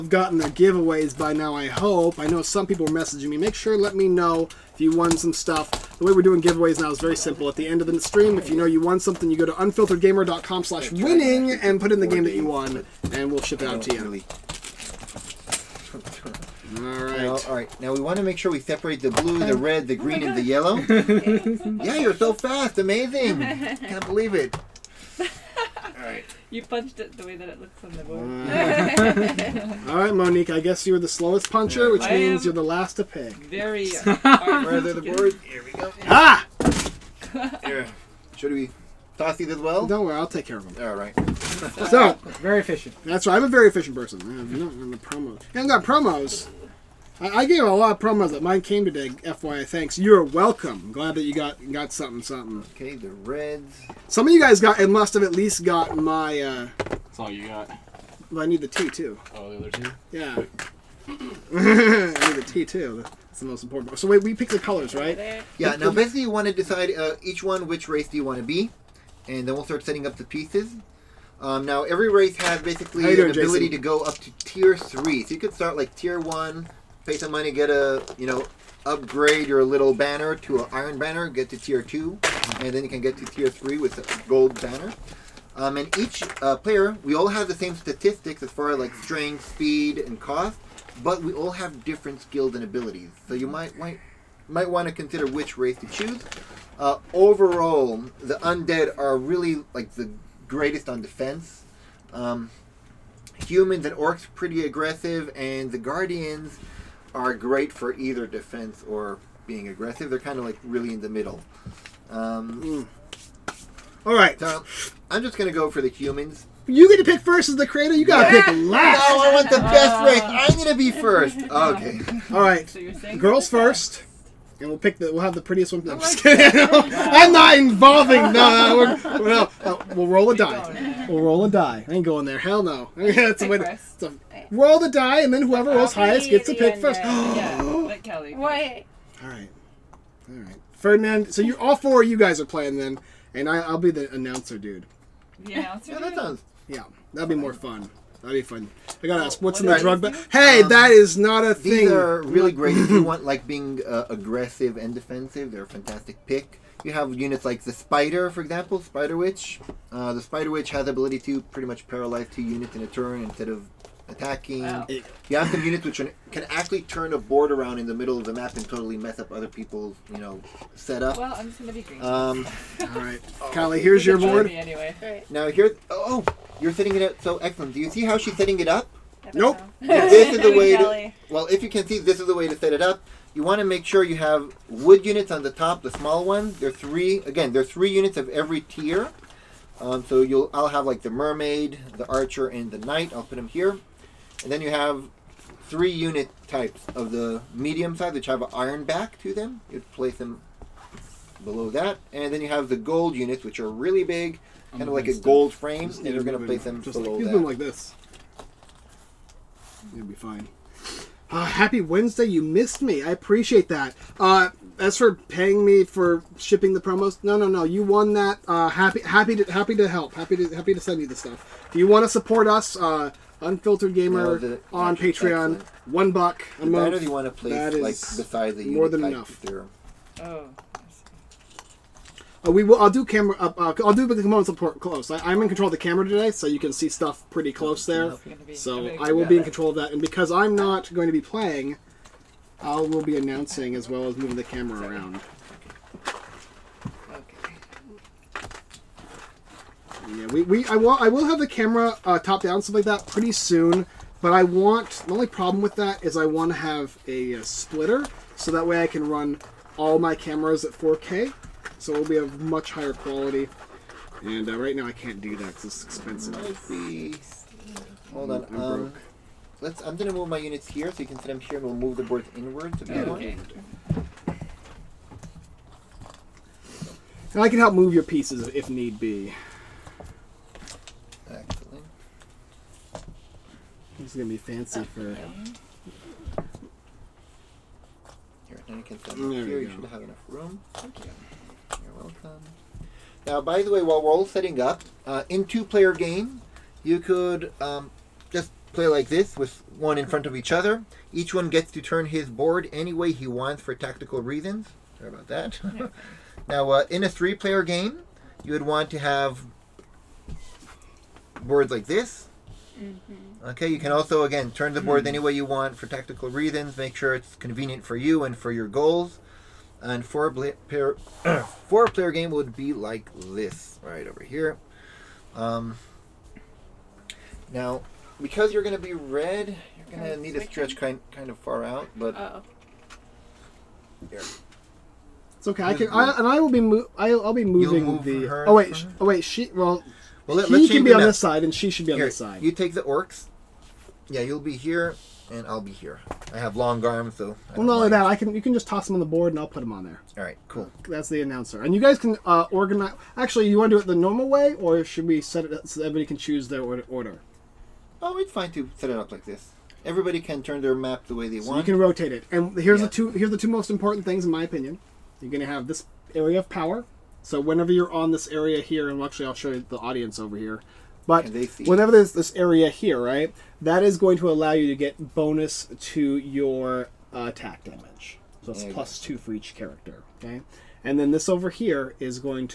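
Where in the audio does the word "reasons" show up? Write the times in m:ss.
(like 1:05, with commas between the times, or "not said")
5:04, 5:16.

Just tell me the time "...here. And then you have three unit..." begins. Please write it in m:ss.
3:13.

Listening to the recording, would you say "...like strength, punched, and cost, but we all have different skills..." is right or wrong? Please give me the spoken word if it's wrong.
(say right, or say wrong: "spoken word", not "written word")
wrong: "speed", not "punched".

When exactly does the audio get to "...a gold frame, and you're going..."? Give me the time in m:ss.
3:25.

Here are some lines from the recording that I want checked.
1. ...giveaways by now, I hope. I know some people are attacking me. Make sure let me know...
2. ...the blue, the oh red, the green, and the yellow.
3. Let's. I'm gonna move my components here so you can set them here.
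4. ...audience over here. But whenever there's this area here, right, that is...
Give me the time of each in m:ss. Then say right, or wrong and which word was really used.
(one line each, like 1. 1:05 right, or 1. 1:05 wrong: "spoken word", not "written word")
1. 0:00 wrong: "messaging", not "attacking"
2. 0:19 right
3. 4:29 wrong: "units", not "components"
4. 6:09 right.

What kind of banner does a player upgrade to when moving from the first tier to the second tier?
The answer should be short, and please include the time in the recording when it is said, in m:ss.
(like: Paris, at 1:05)
Iron banner, at 1:20.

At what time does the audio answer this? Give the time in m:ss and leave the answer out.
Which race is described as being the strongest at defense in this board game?
1:38.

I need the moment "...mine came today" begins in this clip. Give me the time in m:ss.
0:48.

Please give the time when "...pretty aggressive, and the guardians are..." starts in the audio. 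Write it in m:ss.
1:44.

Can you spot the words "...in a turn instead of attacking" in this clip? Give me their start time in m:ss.
2:42.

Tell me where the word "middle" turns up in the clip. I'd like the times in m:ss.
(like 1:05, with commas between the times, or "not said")
1:51, 2:47.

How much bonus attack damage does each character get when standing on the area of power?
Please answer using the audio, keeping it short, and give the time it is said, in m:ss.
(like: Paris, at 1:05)
2, at 6:18.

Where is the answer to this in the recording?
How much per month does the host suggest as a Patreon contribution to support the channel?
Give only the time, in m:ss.
3:45.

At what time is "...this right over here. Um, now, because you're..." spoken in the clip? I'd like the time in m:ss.
5:23.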